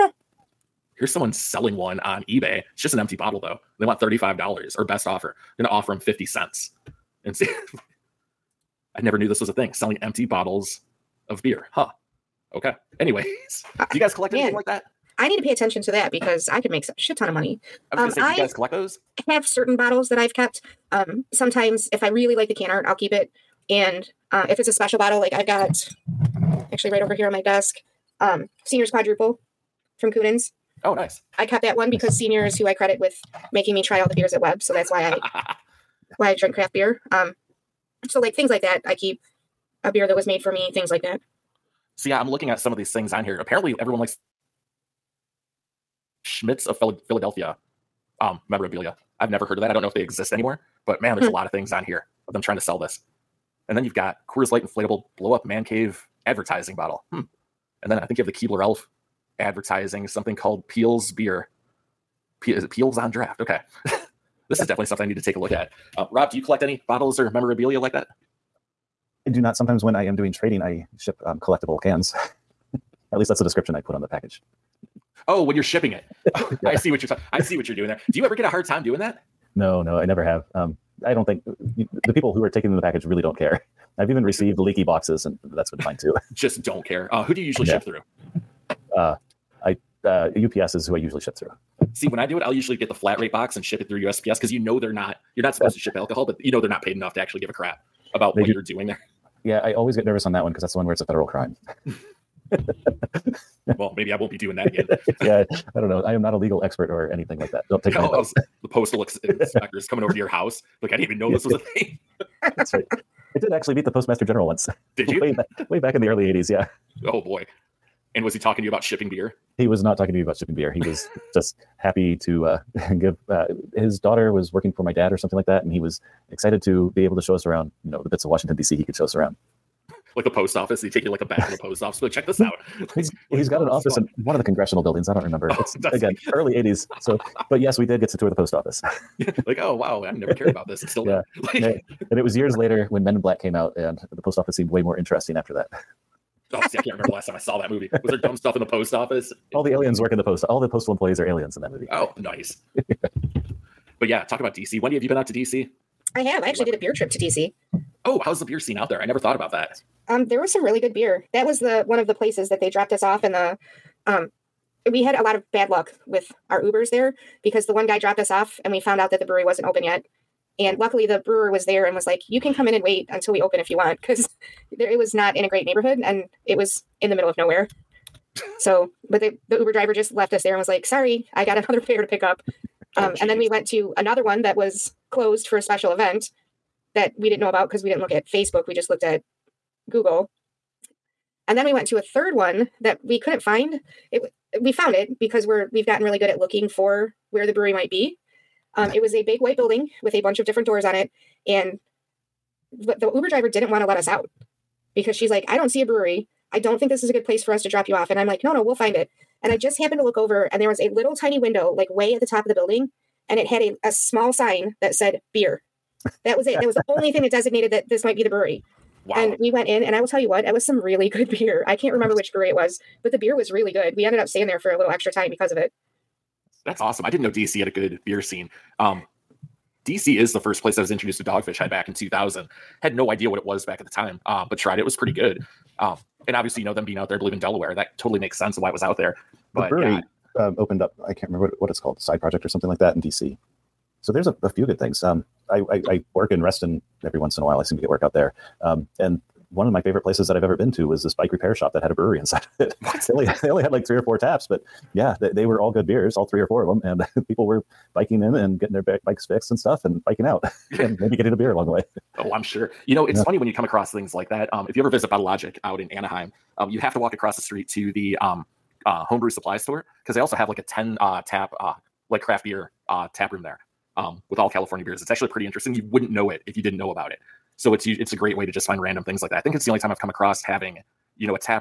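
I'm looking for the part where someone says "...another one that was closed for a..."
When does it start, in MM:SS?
03:03.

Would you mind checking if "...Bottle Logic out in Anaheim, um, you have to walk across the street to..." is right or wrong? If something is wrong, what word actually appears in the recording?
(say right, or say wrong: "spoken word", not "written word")
right.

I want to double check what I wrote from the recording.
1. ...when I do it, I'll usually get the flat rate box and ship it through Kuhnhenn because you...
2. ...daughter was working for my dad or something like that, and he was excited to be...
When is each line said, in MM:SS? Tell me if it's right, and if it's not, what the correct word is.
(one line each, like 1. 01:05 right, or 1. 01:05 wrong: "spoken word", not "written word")
1. 01:32 wrong: "USPS", not "Kuhnhenn"
2. 02:03 right.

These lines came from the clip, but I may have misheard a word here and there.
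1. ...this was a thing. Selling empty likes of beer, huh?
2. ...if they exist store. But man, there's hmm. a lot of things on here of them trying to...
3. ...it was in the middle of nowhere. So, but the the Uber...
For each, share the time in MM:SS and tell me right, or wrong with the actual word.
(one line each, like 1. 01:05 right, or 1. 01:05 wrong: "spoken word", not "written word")
1. 00:09 wrong: "bottles", not "likes"
2. 00:49 wrong: "anymore", not "store"
3. 02:56 right.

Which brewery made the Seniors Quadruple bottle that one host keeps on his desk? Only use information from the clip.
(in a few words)
Kuhnhenn's.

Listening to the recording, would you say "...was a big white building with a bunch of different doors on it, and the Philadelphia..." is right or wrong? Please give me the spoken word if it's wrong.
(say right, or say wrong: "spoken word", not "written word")
wrong: "Uber", not "Philadelphia".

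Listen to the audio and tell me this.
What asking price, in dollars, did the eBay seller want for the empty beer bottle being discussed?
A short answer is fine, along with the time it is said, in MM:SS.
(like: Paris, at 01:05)
$35, at 00:03.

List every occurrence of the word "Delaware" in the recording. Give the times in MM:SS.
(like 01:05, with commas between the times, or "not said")
03:57.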